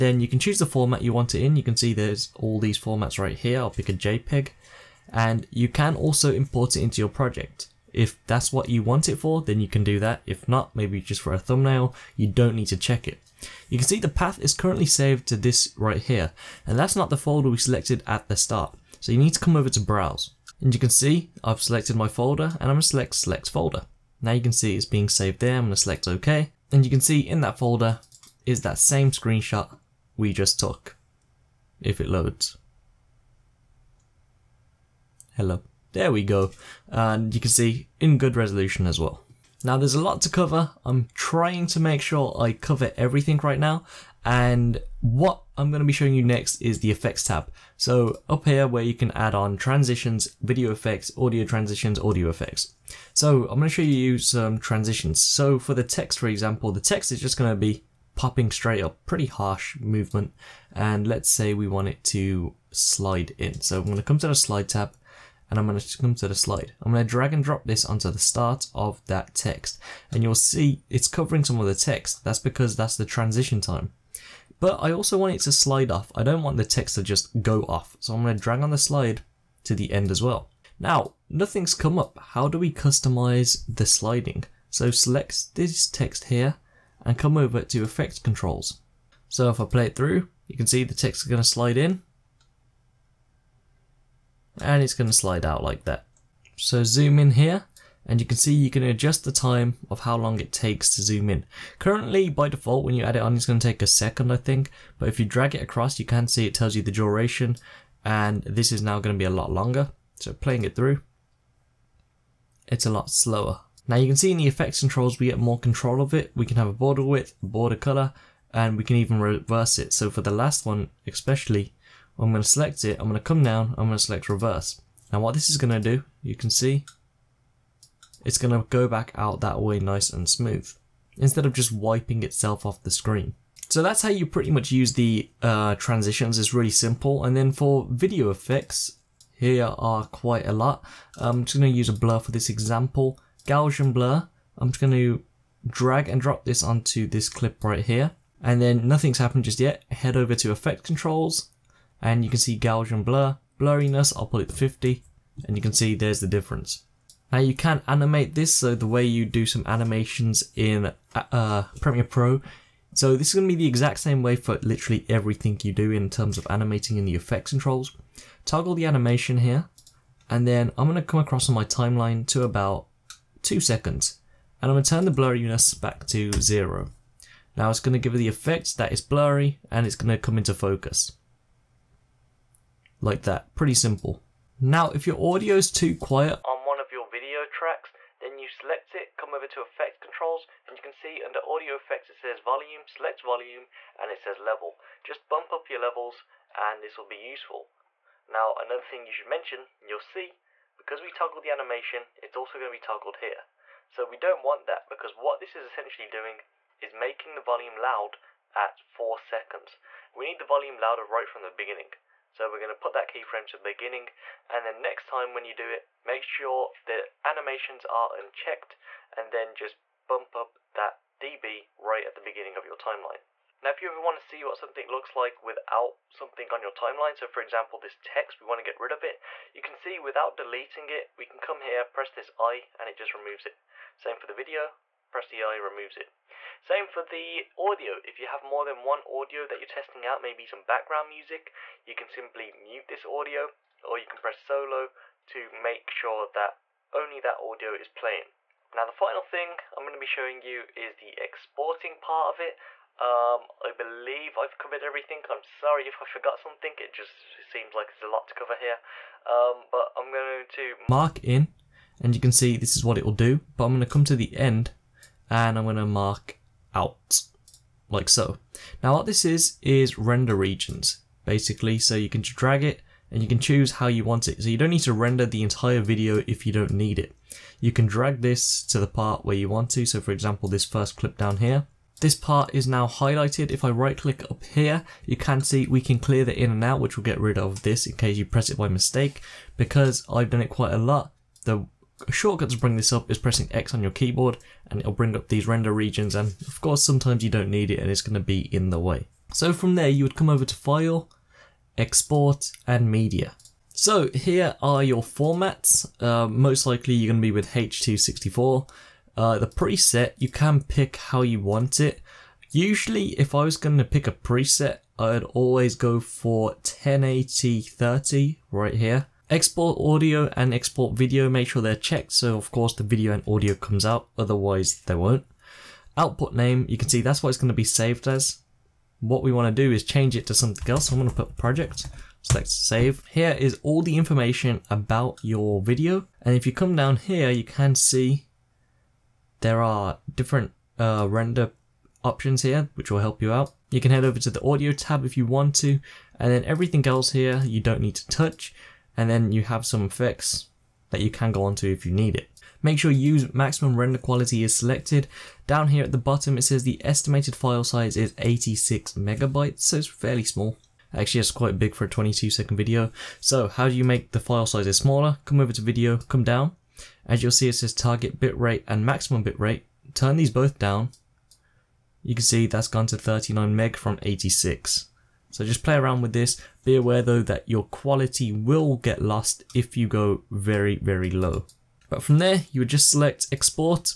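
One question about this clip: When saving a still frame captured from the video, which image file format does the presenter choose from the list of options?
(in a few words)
JPEG.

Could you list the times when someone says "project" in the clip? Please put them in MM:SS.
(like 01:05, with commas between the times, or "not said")
00:07, 05:31.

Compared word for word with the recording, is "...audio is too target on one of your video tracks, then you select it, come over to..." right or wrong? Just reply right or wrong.
wrong.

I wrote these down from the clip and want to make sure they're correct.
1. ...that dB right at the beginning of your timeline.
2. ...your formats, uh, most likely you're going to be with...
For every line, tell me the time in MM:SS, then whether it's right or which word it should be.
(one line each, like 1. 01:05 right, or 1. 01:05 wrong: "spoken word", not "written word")
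1. 03:40 right
2. 05:04 right.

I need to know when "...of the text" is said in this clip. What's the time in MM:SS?
01:11.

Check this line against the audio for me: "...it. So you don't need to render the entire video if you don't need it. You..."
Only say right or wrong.
right.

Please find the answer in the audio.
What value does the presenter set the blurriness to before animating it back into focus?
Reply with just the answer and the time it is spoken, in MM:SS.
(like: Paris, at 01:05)
50, at 02:34.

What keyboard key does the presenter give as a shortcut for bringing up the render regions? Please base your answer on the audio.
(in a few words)
X.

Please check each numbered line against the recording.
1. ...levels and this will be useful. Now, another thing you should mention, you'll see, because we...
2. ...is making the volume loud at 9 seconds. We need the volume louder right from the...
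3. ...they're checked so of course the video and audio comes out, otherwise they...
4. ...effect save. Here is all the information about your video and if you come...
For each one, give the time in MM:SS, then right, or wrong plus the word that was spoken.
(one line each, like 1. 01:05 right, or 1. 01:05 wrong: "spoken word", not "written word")
1. 03:15 right
2. 03:26 wrong: "4", not "9"
3. 05:21 right
4. 05:32 wrong: "select", not "effect".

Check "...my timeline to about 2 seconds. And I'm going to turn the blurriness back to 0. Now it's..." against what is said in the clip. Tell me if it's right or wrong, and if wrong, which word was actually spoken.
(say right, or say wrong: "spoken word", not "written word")
right.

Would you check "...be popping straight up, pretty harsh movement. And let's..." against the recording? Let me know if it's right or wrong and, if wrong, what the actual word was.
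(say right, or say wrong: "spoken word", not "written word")
right.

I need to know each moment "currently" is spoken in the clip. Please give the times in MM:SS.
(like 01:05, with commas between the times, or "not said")
00:14, 01:41.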